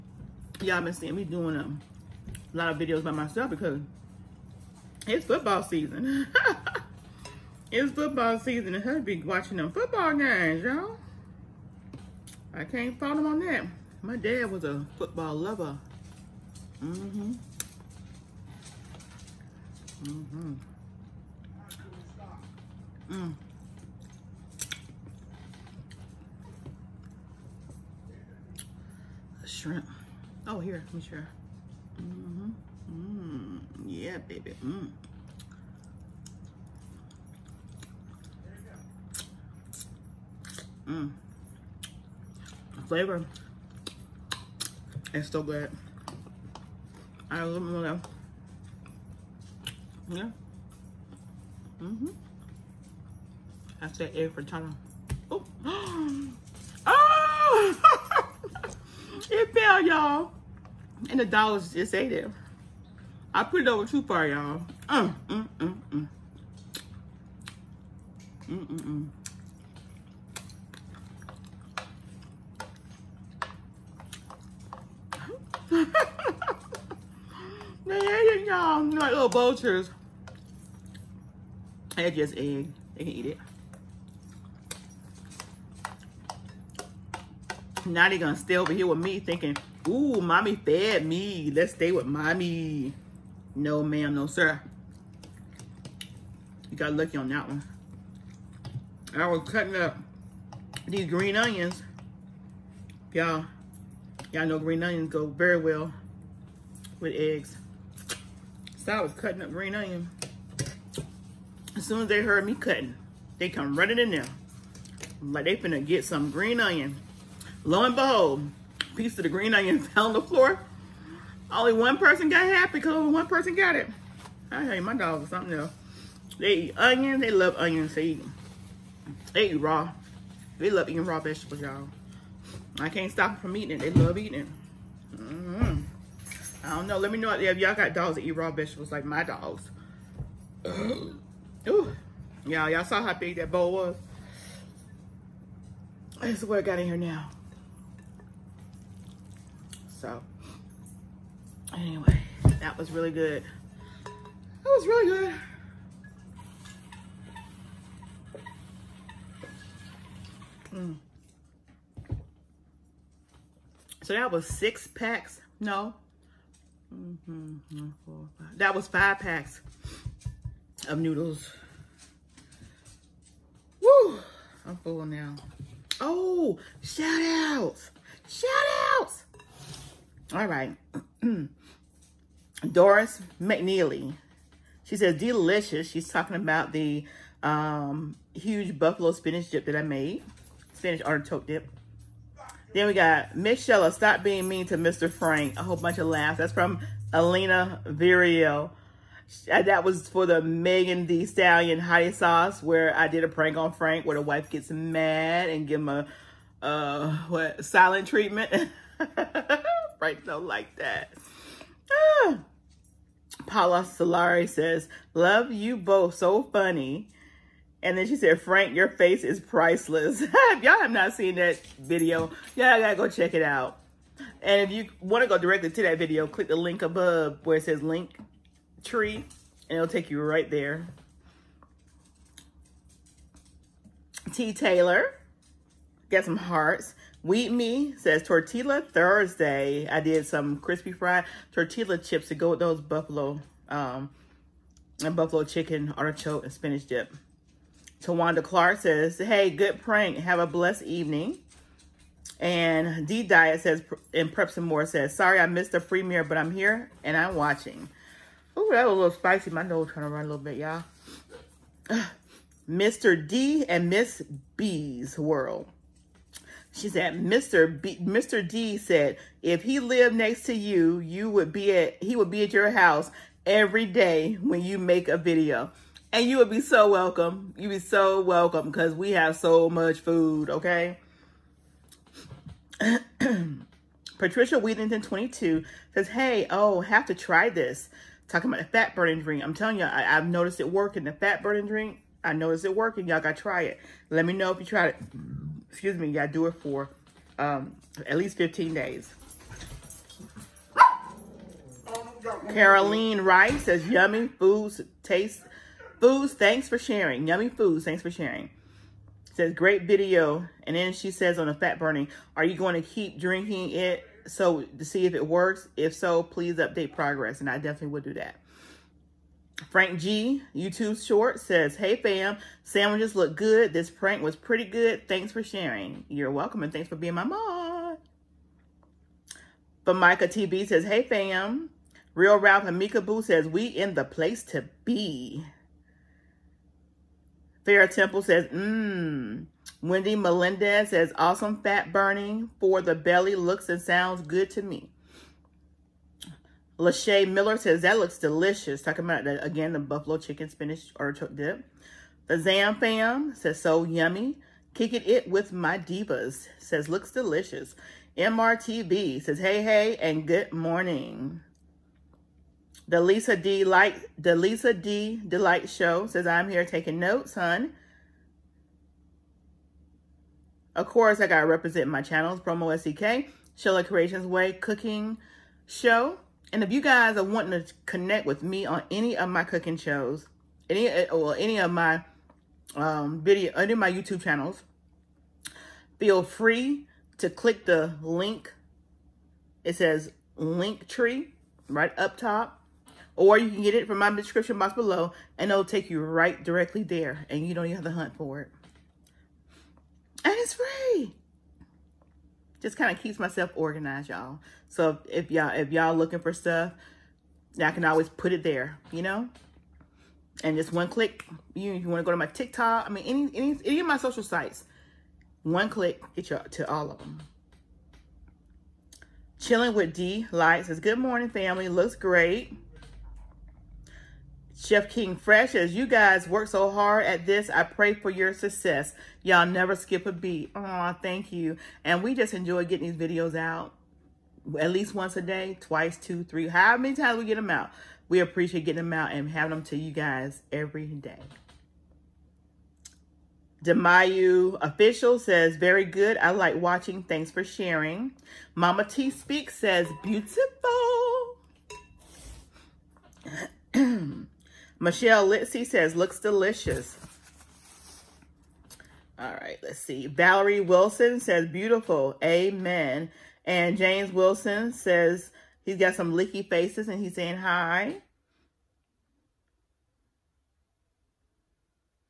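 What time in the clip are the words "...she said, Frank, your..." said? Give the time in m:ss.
3:38.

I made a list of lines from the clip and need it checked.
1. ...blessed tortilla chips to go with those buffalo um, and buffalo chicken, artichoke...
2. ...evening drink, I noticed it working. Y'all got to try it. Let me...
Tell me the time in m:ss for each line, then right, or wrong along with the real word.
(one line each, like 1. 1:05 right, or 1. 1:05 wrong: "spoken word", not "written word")
1. 4:00 wrong: "fried", not "blessed"
2. 4:51 wrong: "burning", not "evening".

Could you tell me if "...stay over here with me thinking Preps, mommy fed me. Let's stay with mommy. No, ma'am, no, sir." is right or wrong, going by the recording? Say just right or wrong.
wrong.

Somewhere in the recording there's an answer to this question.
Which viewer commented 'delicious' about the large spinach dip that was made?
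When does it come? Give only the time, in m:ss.
3:02.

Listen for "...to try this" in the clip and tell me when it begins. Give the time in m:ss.
4:47.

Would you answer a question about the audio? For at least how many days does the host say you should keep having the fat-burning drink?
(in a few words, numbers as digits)
15.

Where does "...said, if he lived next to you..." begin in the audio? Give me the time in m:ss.
4:28.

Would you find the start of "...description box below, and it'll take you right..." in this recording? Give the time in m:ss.
6:34.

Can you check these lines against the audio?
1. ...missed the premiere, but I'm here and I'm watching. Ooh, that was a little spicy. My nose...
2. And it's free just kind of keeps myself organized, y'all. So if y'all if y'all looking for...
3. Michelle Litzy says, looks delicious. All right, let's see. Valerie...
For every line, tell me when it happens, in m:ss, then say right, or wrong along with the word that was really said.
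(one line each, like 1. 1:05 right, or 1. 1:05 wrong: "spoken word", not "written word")
1. 4:15 right
2. 6:40 right
3. 7:34 right.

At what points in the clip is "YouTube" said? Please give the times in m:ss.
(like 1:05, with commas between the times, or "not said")
5:20, 6:23.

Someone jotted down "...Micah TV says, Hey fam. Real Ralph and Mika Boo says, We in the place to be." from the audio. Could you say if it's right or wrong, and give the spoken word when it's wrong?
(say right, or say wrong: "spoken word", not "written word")
right.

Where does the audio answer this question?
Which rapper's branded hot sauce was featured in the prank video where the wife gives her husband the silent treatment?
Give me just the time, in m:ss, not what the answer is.
3:20.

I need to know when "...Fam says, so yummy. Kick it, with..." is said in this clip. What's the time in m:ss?
5:52.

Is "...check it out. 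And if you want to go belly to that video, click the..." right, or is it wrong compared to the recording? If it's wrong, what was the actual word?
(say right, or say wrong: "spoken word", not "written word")
wrong: "directly", not "belly".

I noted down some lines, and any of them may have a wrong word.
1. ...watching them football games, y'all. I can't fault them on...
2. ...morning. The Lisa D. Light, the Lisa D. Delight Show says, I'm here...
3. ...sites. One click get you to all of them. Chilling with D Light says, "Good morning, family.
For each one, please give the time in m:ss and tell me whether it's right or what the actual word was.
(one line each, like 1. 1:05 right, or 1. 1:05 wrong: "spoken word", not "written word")
1. 0:09 right
2. 6:00 right
3. 6:54 right.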